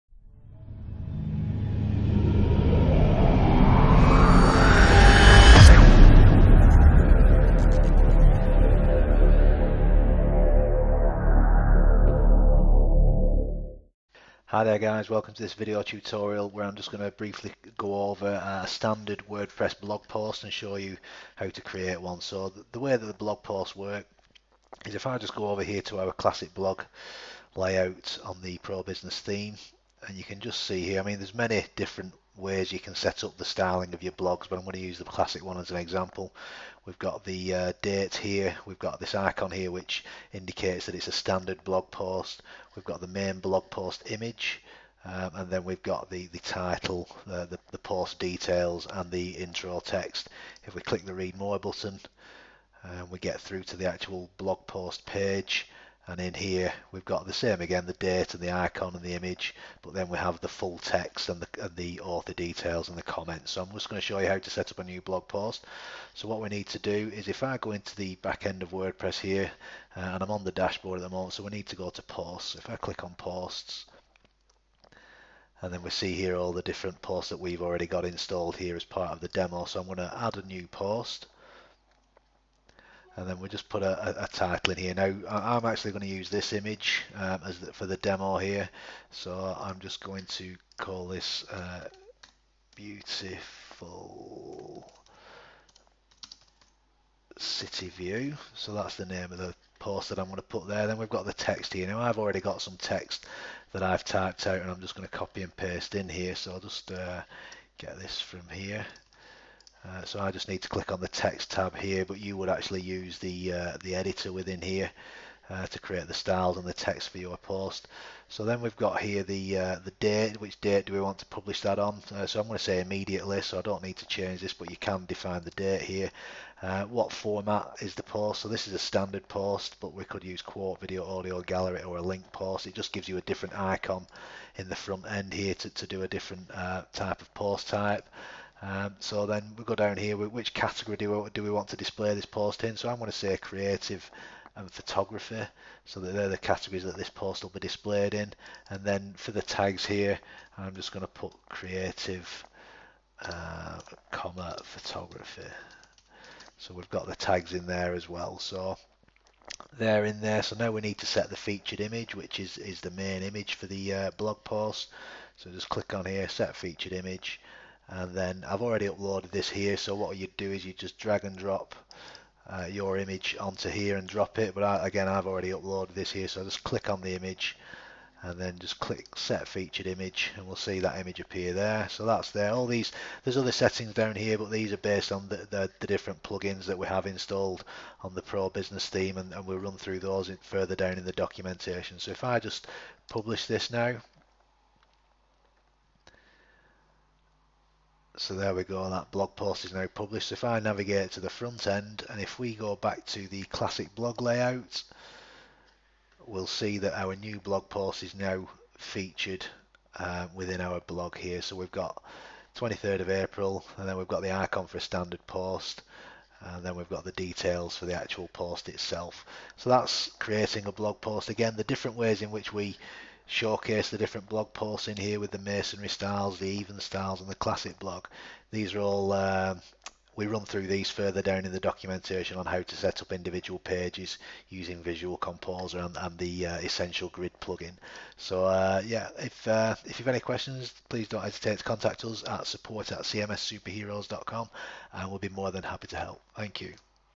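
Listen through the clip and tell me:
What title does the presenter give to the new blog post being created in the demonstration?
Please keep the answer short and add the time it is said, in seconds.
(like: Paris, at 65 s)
Beautiful city view, at 92 s.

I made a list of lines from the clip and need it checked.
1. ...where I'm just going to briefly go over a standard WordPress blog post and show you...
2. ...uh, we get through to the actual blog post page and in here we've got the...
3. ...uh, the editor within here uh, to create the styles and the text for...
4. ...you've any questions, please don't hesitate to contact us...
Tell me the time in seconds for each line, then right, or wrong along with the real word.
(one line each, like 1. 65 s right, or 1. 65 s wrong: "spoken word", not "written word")
1. 16 s right
2. 52 s right
3. 113 s right
4. 239 s right.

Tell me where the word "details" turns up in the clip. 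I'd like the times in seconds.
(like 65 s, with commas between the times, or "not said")
48 s, 62 s, 217 s.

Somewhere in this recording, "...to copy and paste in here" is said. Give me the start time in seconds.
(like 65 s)
105 s.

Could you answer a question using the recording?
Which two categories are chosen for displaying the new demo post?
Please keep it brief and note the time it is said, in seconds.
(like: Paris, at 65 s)
Creative and photography, at 143 s.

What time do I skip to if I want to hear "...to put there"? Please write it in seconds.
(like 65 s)
100 s.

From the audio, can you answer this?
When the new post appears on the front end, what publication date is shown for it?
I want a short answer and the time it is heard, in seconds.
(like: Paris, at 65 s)
23rd of April, at 212 s.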